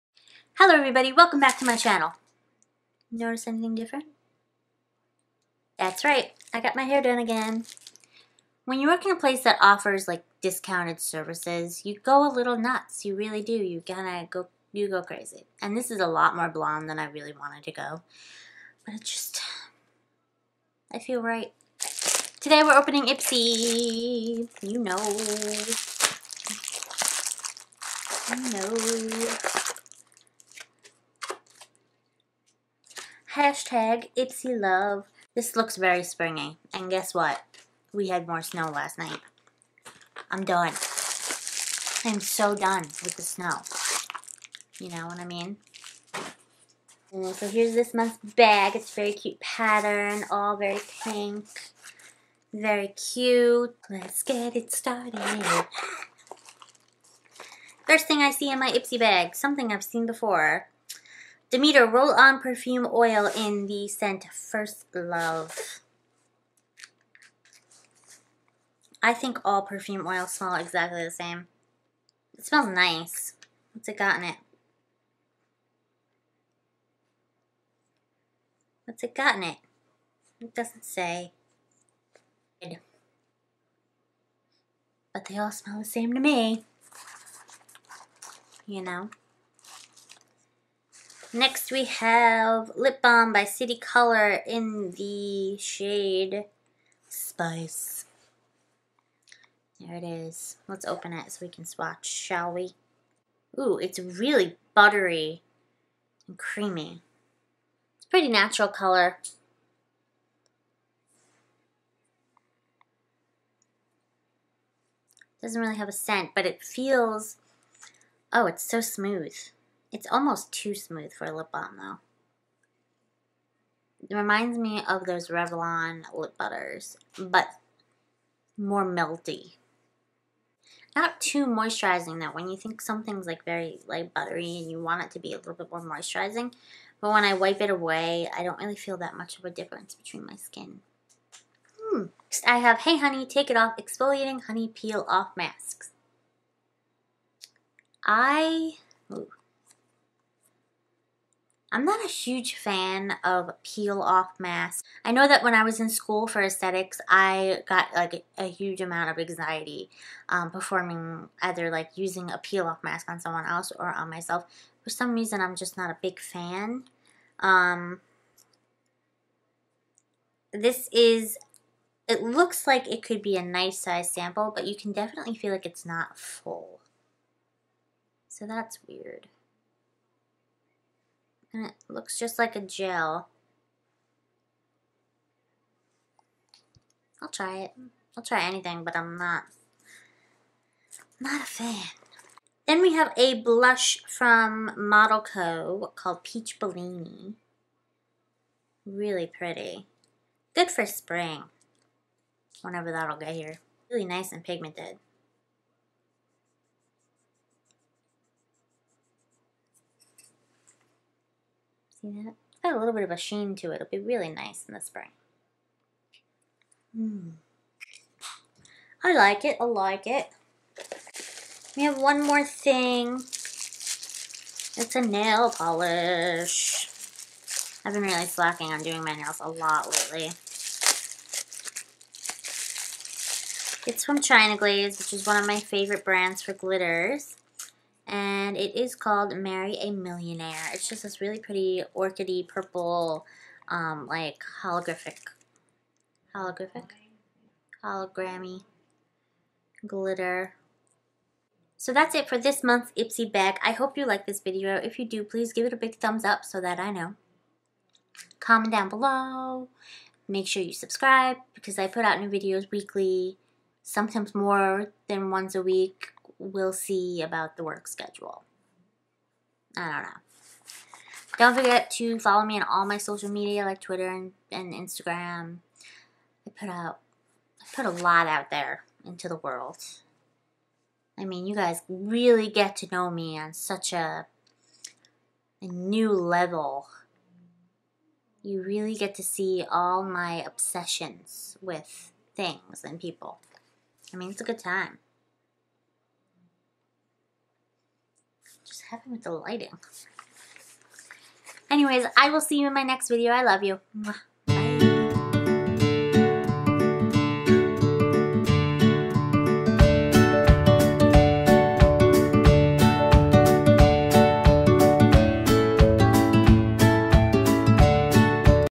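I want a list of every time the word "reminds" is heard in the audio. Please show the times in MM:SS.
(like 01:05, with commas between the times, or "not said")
02:04.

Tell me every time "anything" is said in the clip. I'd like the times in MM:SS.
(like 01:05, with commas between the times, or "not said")
00:03, 03:08.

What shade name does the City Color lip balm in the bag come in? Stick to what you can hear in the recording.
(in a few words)
Spice.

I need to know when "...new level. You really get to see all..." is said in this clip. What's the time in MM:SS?
04:45.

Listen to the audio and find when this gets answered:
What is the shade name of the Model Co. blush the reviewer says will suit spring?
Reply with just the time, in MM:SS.
03:16.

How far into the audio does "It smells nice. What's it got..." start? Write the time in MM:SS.
01:12.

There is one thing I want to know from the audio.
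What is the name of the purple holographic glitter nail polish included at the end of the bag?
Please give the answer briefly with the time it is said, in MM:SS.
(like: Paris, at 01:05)
Marry a Millionaire, at 03:59.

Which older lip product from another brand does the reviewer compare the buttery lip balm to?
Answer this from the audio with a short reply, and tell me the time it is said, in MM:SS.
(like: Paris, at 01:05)
Revlon lip butters, at 02:05.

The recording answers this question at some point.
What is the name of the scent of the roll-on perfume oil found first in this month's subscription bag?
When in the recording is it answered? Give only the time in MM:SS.
01:04.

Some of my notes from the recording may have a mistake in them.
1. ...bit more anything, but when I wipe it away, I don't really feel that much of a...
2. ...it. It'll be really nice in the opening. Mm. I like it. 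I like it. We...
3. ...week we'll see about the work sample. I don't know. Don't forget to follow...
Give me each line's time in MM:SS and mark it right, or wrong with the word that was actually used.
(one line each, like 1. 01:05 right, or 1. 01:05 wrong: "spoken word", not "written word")
1. 02:15 wrong: "moisturizing", not "anything"
2. 03:33 wrong: "spring", not "opening"
3. 04:25 wrong: "schedule", not "sample".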